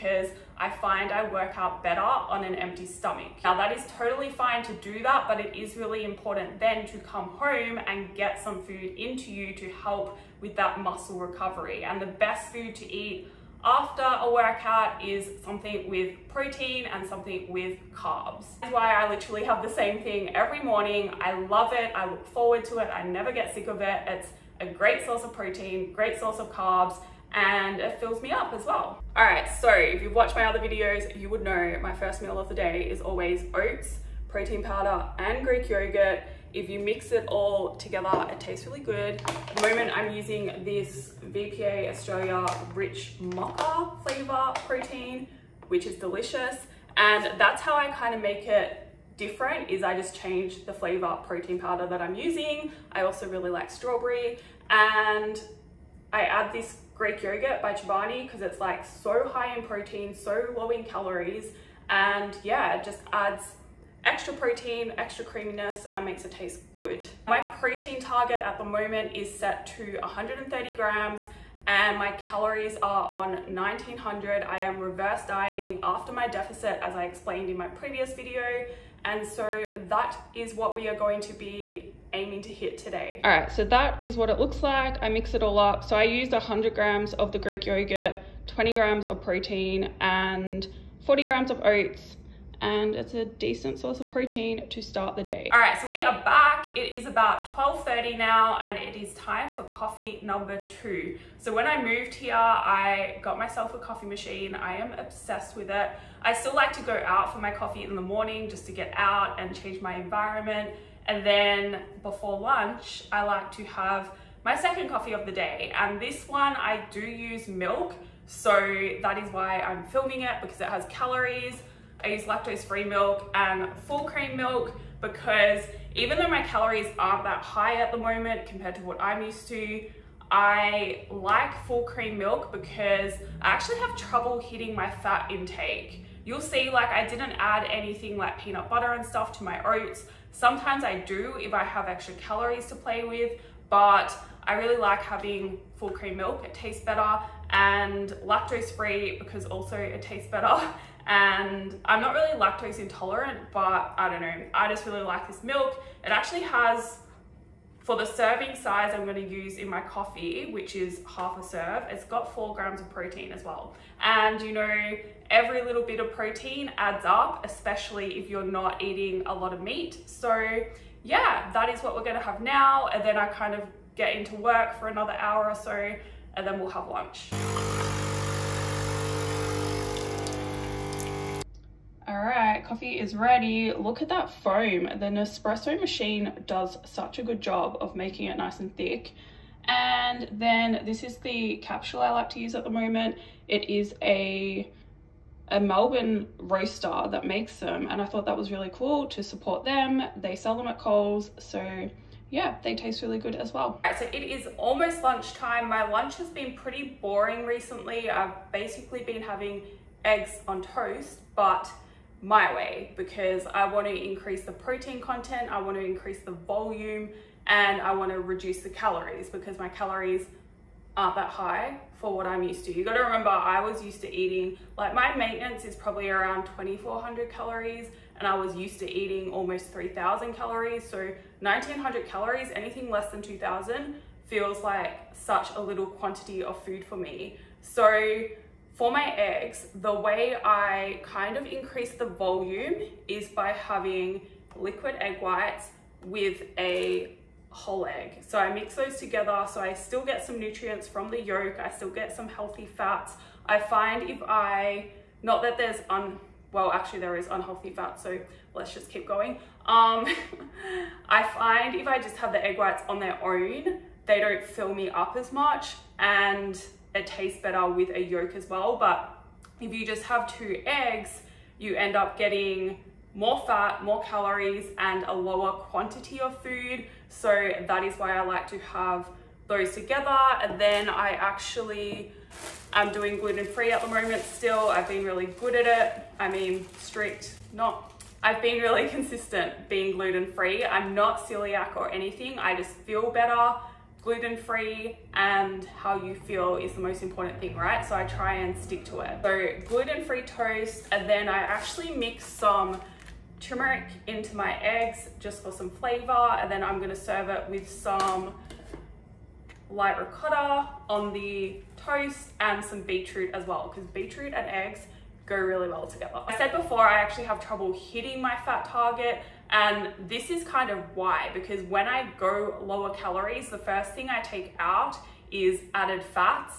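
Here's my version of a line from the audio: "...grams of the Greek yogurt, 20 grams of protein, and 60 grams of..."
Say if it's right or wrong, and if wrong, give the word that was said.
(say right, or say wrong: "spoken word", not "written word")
wrong: "40", not "60".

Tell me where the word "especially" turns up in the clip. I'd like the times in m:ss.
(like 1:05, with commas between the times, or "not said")
2:47.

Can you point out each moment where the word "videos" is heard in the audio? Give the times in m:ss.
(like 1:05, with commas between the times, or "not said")
0:30, 1:18.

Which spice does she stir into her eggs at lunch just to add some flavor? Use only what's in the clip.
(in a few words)
turmeric.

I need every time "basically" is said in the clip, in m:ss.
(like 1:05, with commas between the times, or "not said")
3:28.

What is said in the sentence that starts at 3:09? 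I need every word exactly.
And then this is the capsule I like to use at the moment.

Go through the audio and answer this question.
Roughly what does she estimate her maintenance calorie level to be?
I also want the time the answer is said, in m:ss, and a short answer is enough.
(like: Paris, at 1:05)
2400 calories, at 3:46.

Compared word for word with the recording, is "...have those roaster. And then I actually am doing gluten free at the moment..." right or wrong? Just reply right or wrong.
wrong.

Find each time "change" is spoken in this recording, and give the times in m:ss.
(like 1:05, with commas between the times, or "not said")
0:50, 1:49.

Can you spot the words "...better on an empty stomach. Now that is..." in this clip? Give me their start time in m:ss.
0:01.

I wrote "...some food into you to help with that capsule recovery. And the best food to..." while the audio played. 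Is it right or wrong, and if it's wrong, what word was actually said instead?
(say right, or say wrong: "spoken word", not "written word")
wrong: "muscle", not "capsule".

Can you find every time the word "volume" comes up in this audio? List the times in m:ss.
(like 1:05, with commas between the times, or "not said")
3:36, 4:02.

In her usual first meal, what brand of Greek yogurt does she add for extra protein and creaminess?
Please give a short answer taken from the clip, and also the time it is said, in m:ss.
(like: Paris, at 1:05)
Chobani, at 0:57.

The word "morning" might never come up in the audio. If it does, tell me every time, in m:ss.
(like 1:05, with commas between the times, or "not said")
0:20, 1:48.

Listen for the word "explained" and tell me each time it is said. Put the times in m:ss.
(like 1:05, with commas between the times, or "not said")
1:17.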